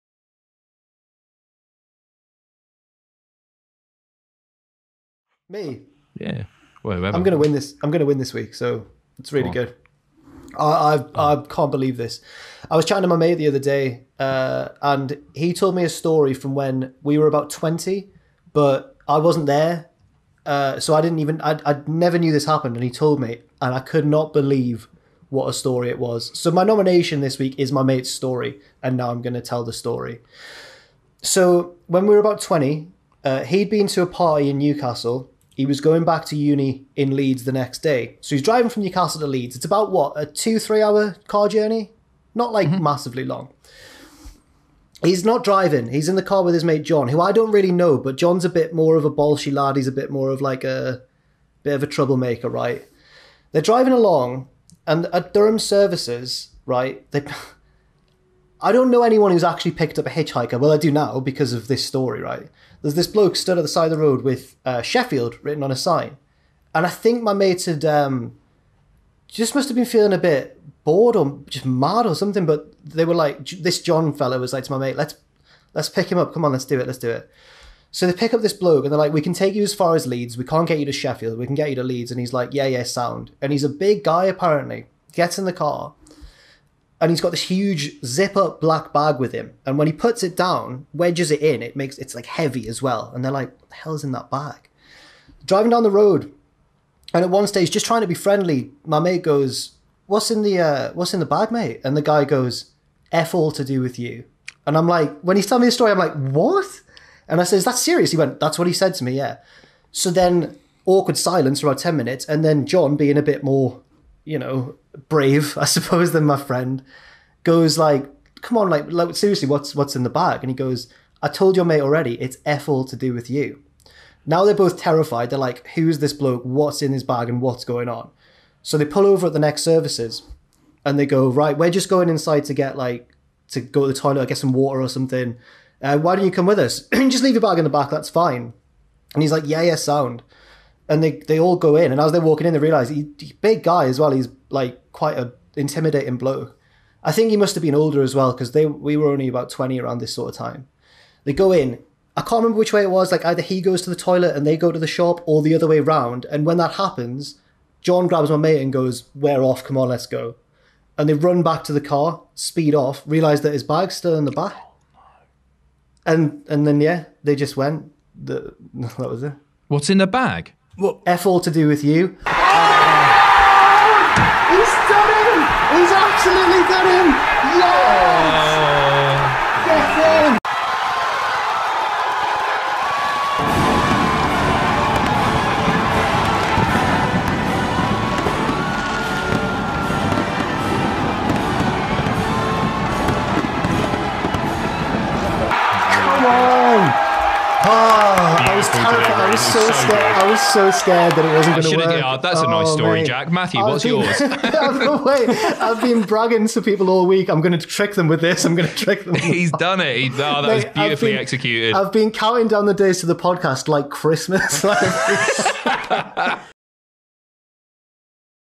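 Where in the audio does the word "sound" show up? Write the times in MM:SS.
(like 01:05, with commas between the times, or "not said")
01:22, 02:19.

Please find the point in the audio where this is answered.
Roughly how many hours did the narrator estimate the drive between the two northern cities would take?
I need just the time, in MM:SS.
00:40.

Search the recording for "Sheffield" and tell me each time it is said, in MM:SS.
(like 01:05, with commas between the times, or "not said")
01:04, 01:20.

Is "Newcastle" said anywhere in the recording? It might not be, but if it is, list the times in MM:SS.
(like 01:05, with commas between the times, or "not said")
00:34, 00:38.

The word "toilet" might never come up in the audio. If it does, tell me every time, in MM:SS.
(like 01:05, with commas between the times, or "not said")
02:13, 02:33.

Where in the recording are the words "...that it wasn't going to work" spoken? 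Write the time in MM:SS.
03:21.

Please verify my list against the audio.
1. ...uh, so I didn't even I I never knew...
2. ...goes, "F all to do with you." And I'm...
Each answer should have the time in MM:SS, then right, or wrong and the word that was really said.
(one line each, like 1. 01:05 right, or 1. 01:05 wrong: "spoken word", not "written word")
1. 00:20 right
2. 01:42 right.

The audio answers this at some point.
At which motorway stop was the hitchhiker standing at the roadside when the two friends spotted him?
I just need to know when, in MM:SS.
00:55.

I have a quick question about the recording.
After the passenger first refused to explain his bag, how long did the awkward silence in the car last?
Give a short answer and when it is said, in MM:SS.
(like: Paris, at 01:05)
10 minutes, at 01:51.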